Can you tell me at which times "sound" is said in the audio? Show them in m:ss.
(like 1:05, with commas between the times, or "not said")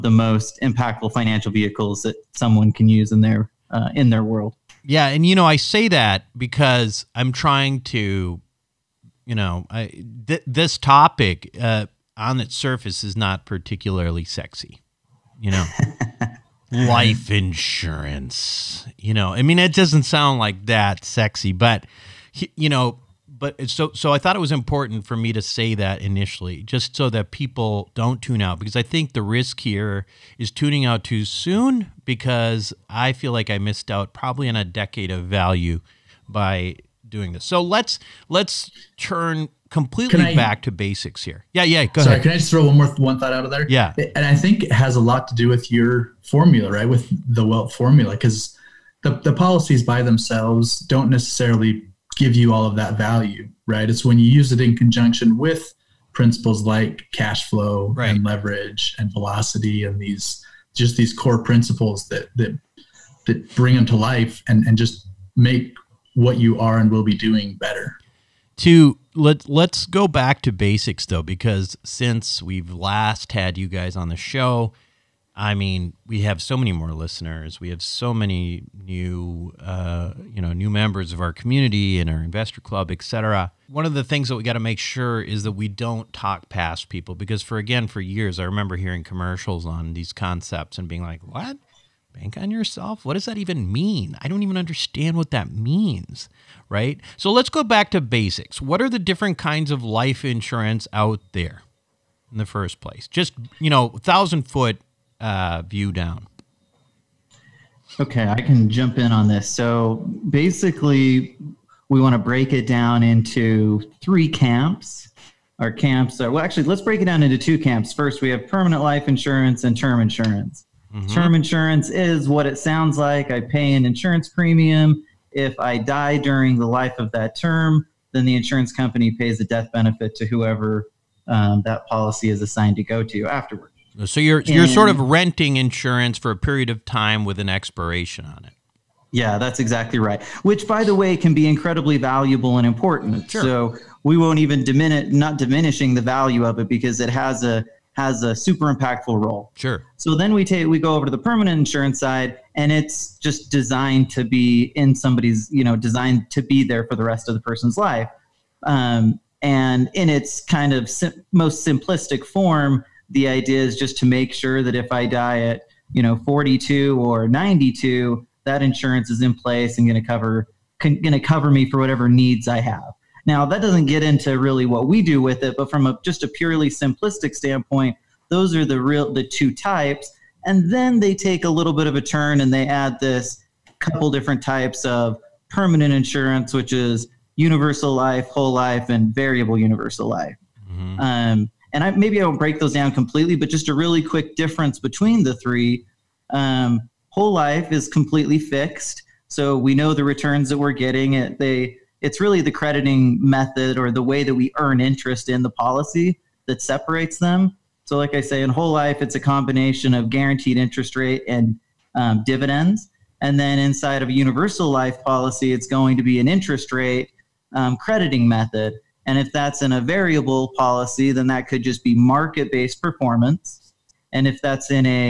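0:20, 2:02.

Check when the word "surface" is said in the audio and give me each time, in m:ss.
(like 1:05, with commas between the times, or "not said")
0:12.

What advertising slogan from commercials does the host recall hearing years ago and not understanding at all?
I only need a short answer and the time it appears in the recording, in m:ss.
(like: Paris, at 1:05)
Bank on yourself, at 1:32.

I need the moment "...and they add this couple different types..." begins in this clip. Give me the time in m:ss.
3:02.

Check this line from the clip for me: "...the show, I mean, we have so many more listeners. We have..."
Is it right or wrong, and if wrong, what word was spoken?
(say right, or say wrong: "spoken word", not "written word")
right.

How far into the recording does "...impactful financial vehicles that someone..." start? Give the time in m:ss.
0:00.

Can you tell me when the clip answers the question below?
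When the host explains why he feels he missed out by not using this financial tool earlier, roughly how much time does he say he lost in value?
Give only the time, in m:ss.
0:34.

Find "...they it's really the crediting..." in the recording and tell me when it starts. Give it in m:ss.
3:21.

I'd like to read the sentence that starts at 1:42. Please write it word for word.
In the first place, just you know, thousand foot uh, view down?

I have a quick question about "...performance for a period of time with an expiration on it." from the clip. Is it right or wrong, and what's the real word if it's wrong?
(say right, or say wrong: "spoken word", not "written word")
wrong: "insurance", not "performance".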